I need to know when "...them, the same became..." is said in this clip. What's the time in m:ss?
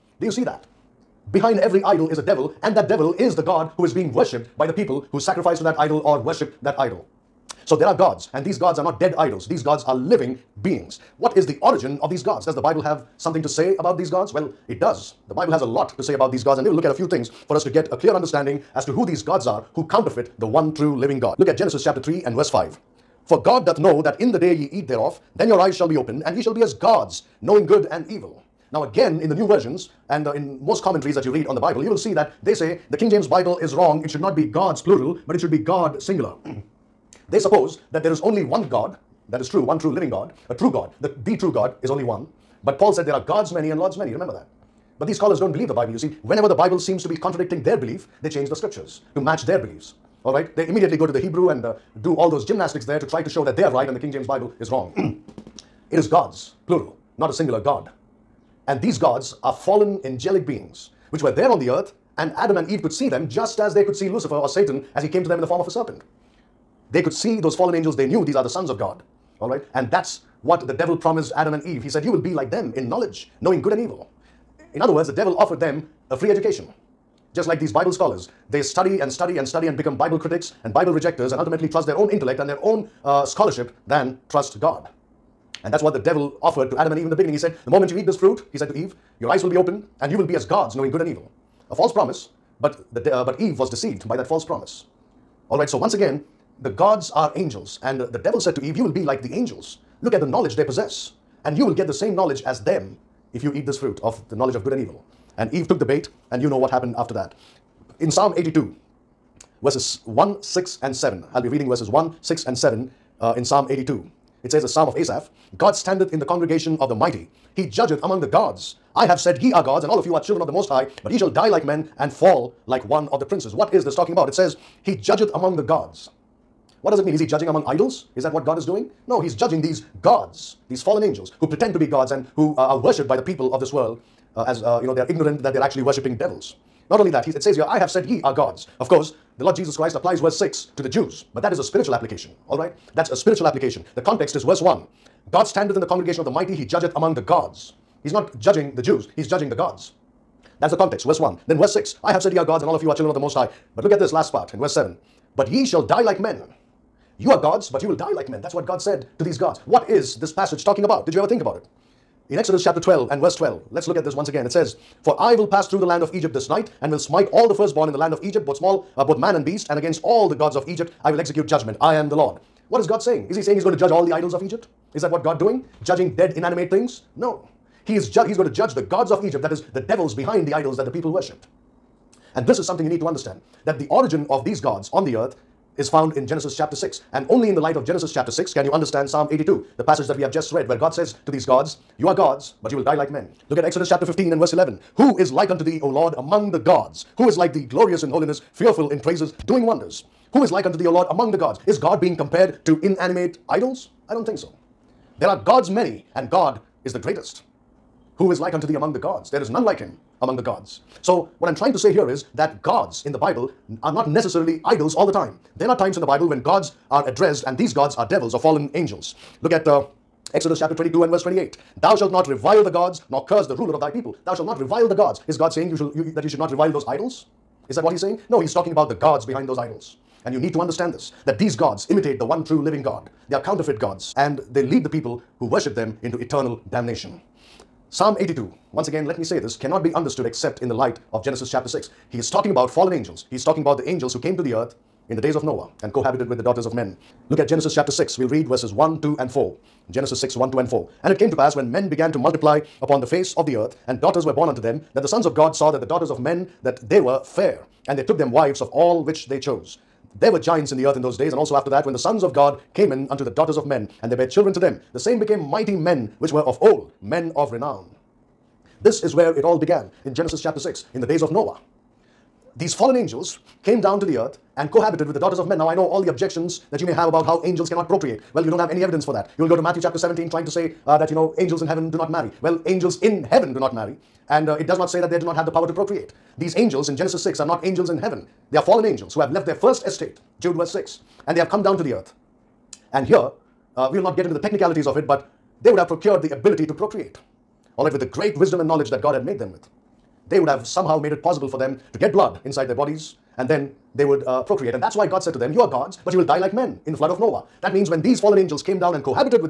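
4:24.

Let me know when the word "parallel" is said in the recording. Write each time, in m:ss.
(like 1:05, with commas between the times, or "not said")
not said.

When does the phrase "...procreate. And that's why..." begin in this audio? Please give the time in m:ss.
5:04.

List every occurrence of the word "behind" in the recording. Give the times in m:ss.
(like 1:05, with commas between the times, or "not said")
0:01, 3:00, 3:49.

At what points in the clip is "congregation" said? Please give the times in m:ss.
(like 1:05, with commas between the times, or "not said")
1:56, 2:25.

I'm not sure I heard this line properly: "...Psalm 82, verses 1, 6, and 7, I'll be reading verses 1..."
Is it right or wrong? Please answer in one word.
right.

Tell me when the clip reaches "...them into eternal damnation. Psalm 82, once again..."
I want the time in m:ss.
3:55.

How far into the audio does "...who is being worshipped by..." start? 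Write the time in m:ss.
0:03.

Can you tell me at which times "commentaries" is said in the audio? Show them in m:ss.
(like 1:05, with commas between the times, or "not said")
0:30.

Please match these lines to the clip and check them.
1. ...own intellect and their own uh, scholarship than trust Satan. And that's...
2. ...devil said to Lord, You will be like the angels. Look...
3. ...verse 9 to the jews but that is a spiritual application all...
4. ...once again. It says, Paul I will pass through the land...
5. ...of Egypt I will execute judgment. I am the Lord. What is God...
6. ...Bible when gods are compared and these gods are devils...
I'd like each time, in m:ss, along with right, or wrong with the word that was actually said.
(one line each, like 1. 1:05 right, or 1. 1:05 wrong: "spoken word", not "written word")
1. 1:21 wrong: "God", not "Satan"
2. 1:38 wrong: "Eve", not "Lord"
3. 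2:20 wrong: "6", not "9"
4. 2:44 wrong: "For", not "Paul"
5. 2:50 right
6. 3:36 wrong: "addressed", not "compared".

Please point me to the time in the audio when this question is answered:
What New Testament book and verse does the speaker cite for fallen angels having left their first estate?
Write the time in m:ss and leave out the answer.
4:50.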